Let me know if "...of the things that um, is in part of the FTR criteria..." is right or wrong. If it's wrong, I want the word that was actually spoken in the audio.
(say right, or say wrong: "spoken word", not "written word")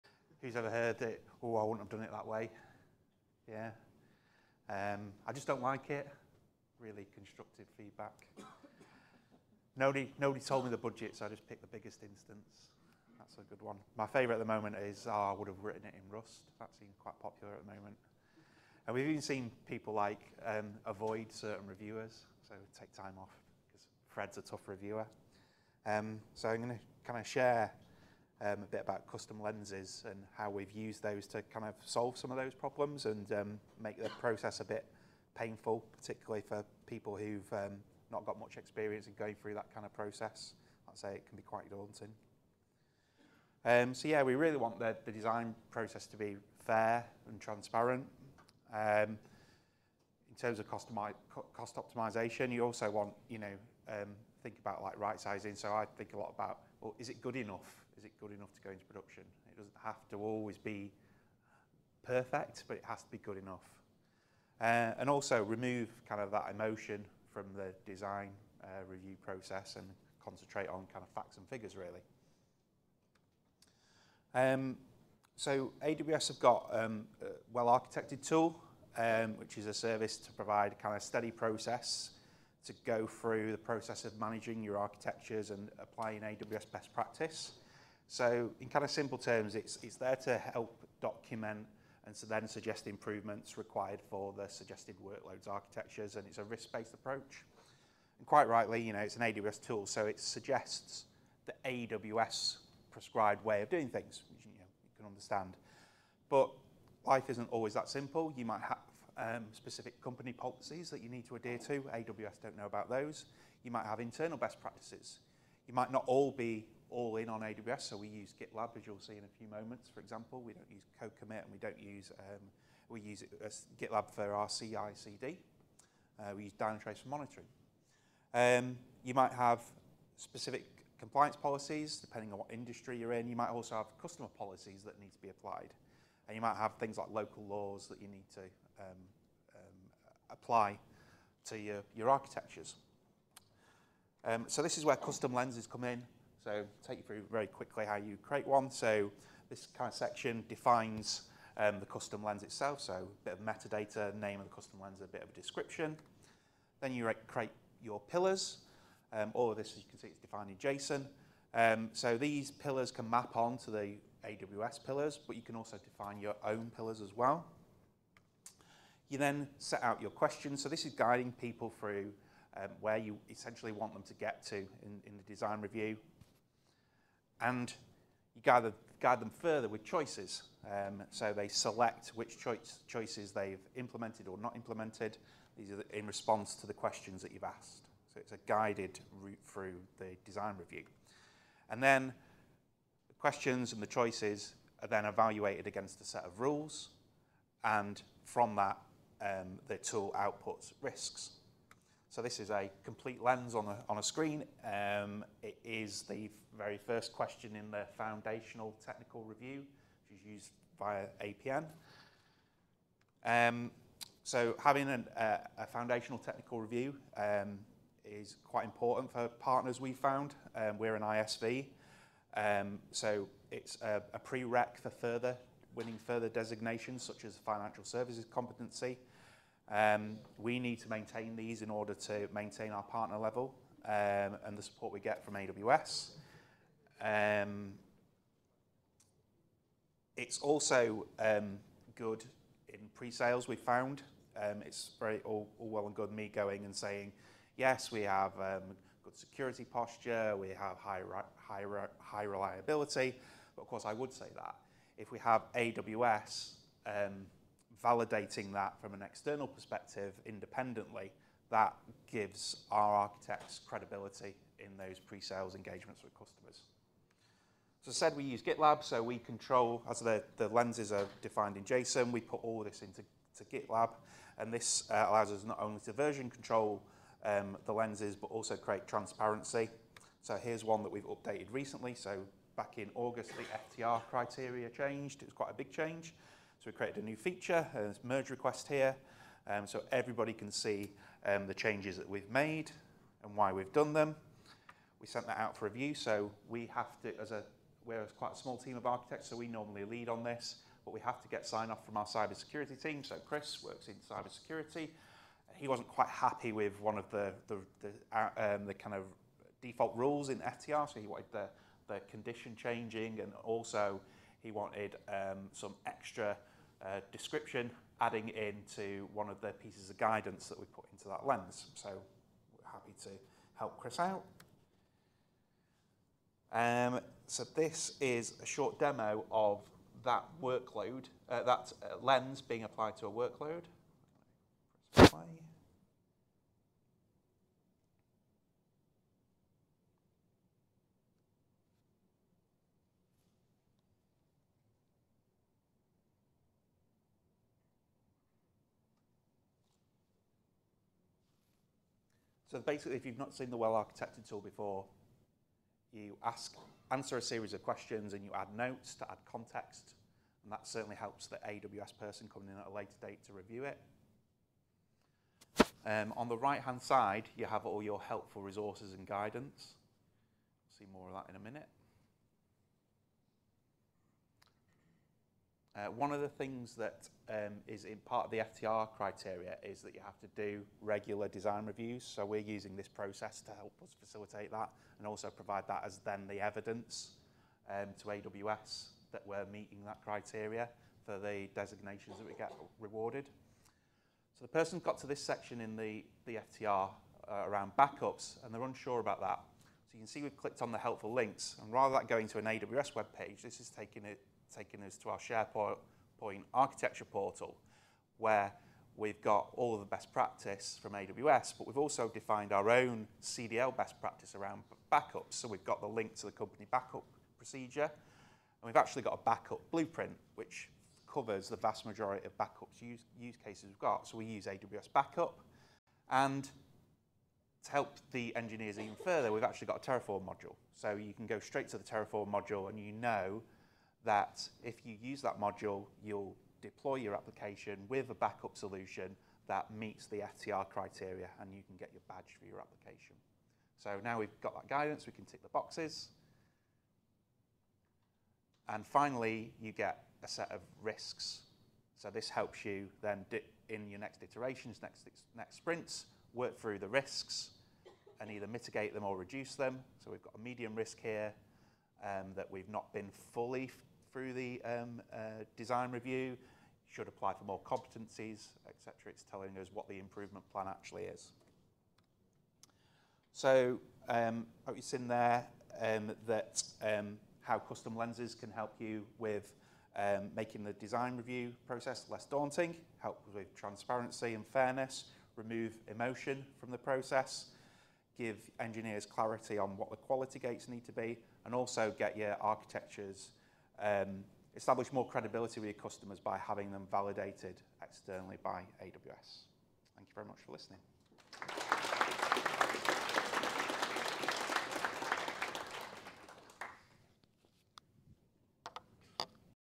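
right.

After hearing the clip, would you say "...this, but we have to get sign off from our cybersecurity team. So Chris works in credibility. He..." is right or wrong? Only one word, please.
wrong.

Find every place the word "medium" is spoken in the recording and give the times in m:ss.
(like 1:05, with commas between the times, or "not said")
7:40.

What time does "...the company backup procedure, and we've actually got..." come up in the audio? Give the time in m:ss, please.
6:56.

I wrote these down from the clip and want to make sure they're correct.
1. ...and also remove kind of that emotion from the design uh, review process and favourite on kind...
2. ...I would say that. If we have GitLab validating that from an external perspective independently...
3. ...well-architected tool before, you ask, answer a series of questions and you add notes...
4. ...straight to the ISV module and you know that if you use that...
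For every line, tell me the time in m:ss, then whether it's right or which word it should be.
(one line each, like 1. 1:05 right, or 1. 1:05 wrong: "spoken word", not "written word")
1. 1:04 wrong: "concentrate", not "favourite"
2. 4:13 wrong: "AWS", not "GitLab"
3. 5:53 right
4. 7:11 wrong: "Terraform", not "ISV".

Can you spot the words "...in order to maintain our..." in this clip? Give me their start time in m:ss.
3:51.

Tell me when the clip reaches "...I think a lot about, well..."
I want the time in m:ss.
0:55.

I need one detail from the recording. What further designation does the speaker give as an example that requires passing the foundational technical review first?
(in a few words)
Financial services competency.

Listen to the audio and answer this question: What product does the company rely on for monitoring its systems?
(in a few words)
Dynatrace.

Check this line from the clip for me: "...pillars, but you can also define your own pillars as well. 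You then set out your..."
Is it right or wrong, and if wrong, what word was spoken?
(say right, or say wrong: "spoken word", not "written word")
right.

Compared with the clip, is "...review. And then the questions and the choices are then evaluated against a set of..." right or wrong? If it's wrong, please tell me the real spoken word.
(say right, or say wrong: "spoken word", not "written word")
right.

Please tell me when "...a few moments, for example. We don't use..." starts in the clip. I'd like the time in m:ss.
1:59.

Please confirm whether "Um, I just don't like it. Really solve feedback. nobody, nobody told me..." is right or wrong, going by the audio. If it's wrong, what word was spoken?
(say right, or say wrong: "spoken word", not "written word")
wrong: "constructive", not "solve".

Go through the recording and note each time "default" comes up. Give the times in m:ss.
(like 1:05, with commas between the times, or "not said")
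5:09.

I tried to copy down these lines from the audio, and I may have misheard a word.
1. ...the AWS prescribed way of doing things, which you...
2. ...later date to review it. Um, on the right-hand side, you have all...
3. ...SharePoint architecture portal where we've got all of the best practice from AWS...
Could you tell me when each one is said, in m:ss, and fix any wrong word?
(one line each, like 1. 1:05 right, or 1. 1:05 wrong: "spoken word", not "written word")
1. 1:41 right
2. 6:02 right
3. 6:45 right.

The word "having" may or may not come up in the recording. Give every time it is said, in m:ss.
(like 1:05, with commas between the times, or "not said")
3:34, 8:16.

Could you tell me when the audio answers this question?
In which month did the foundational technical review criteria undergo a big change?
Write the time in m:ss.
4:42.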